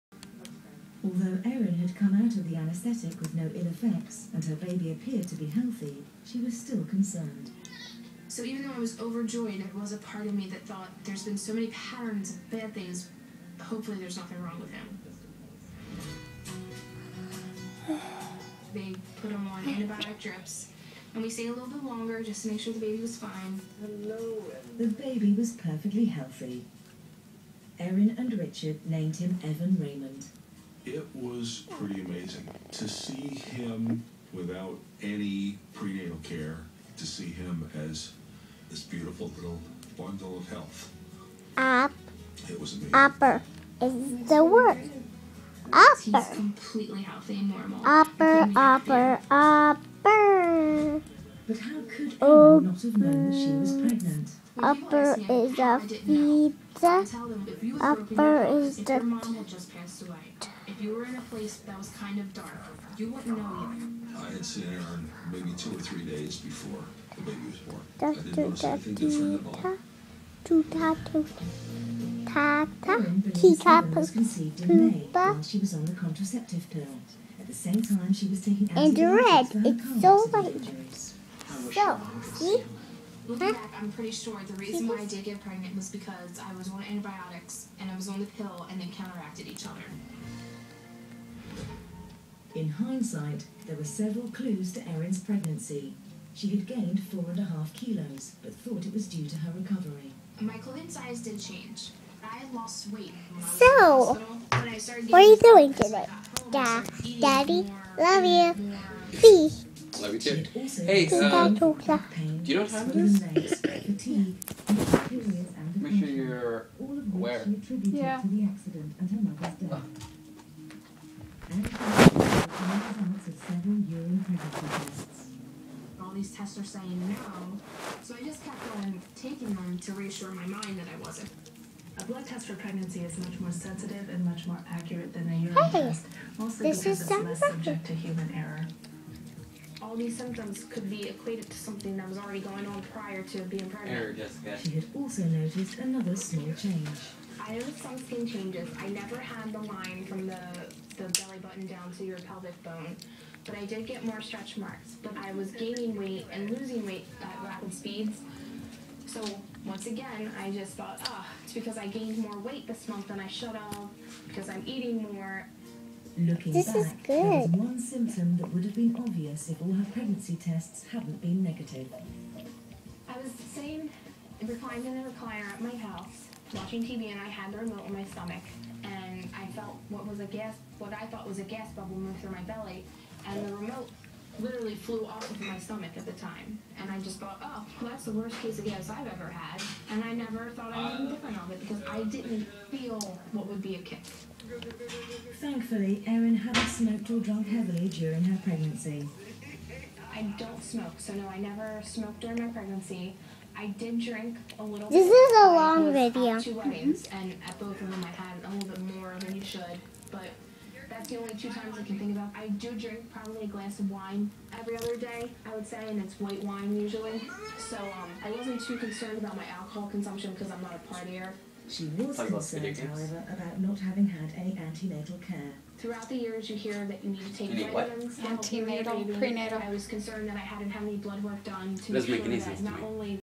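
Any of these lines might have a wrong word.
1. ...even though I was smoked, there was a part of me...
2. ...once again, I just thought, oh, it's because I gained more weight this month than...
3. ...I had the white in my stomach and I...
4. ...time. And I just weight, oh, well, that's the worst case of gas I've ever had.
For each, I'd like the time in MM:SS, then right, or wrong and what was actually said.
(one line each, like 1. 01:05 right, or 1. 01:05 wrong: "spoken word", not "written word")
1. 00:08 wrong: "overjoyed", not "smoked"
2. 02:39 right
3. 02:57 wrong: "remote", not "white"
4. 03:06 wrong: "thought", not "weight".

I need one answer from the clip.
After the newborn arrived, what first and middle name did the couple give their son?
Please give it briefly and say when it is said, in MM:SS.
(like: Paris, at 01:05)
Evan Raymond, at 00:29.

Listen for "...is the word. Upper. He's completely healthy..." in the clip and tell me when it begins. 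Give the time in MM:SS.
00:43.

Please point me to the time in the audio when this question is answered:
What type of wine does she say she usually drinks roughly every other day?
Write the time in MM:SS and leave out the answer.
03:36.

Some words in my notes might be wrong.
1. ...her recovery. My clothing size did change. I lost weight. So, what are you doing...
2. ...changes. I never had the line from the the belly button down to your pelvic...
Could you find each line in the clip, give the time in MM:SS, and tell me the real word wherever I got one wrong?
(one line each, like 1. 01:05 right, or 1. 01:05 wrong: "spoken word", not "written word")
1. 01:39 right
2. 02:28 right.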